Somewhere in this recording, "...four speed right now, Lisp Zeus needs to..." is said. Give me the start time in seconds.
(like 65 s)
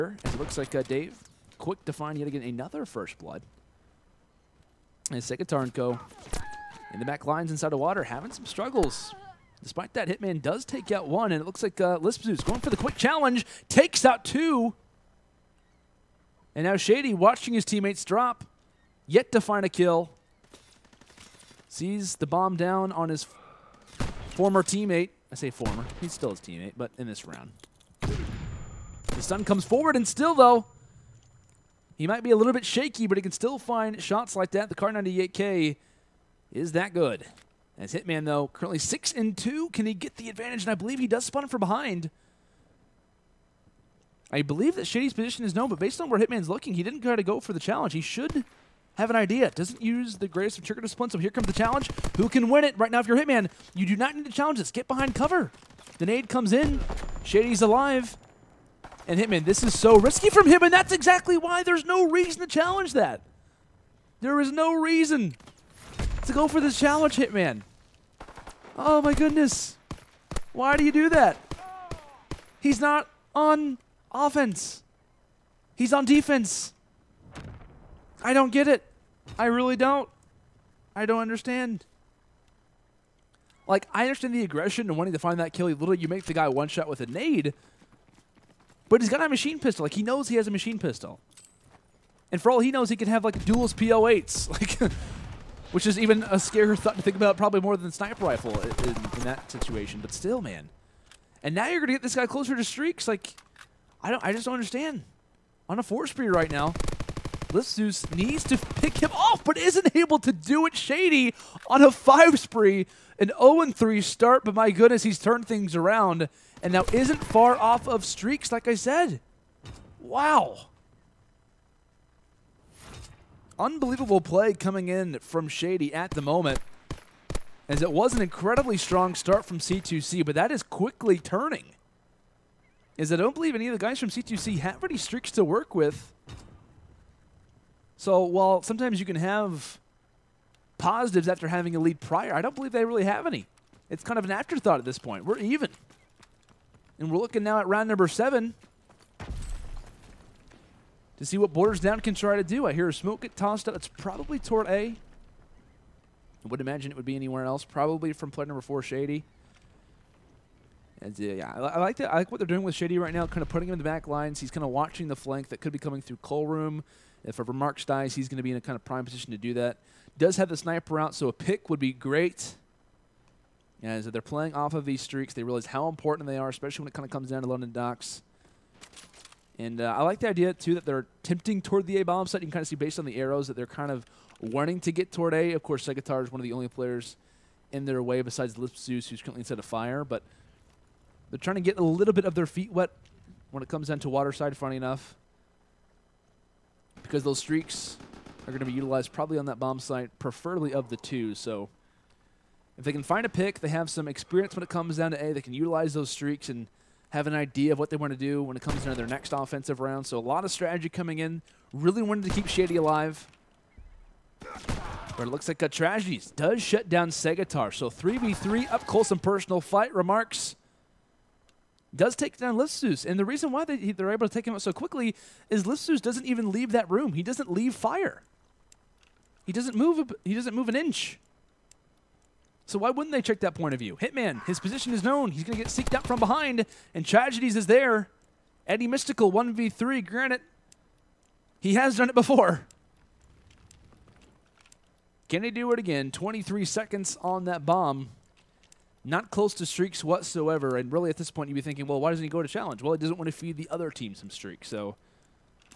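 105 s.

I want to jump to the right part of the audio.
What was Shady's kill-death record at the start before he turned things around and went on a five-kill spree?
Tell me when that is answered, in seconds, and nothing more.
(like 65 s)
113 s.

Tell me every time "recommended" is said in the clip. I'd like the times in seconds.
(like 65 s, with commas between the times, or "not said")
not said.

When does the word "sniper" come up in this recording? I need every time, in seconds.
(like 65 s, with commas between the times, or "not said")
97 s, 170 s.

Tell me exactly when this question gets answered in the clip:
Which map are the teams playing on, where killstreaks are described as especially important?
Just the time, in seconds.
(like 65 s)
177 s.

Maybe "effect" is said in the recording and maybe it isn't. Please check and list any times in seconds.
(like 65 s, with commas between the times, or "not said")
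not said.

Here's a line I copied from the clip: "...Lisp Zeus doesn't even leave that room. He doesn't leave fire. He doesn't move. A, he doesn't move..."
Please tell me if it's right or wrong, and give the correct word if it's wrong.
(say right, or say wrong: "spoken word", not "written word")
right.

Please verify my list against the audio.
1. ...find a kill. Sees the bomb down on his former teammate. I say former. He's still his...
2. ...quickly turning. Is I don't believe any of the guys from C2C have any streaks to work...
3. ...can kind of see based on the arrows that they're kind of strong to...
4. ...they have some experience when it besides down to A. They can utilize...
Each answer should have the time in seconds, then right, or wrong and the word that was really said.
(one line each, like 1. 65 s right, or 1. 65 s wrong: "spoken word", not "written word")
1. 19 s right
2. 130 s right
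3. 182 s wrong: "wanting", not "strong"
4. 203 s wrong: "comes", not "besides".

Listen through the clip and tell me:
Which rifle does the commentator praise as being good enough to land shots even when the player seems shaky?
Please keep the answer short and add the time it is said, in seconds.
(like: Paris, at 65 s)
Kar98k, at 34 s.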